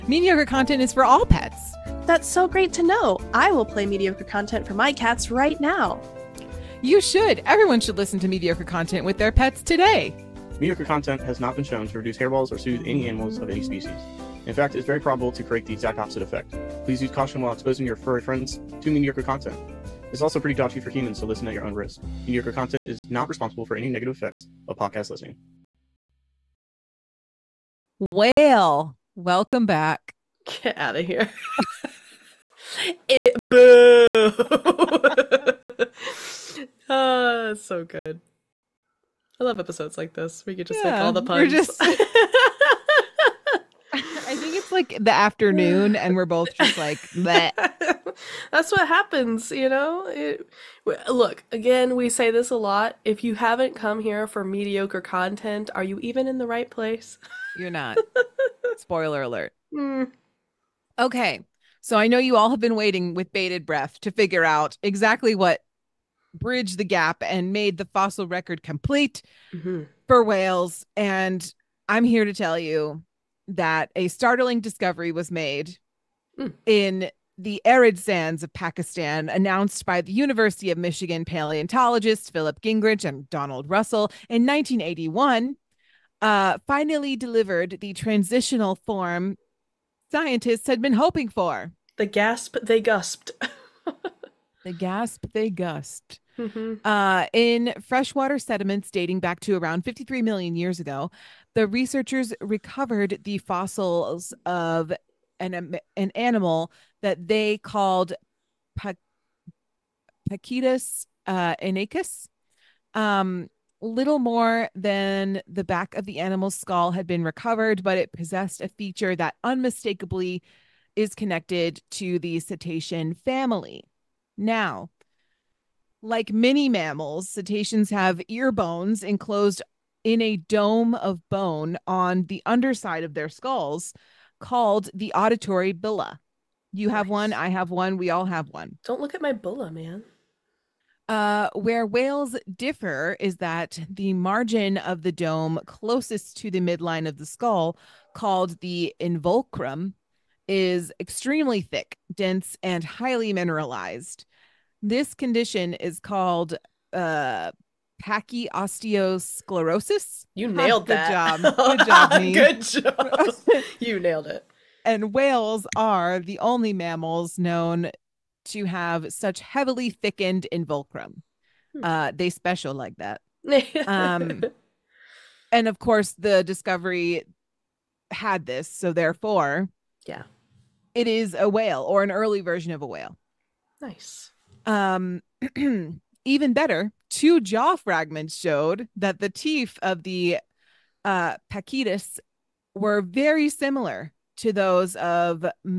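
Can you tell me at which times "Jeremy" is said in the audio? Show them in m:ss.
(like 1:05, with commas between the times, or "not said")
not said.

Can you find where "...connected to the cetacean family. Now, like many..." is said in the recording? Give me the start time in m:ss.
2:01.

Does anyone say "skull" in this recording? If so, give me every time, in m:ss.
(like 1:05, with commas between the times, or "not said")
1:56, 2:13, 2:27.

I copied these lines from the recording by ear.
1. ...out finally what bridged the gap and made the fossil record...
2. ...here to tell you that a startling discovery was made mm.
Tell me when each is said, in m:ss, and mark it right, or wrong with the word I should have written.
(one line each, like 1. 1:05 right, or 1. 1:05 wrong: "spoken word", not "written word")
1. 1:04 wrong: "exactly", not "finally"
2. 1:12 right.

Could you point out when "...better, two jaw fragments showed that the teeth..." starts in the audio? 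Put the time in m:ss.
3:06.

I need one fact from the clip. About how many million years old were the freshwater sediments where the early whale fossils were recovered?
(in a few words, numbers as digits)
53 million.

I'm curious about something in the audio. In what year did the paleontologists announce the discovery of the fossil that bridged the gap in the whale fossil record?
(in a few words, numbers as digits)
1981.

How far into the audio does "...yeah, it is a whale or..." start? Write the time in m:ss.
3:00.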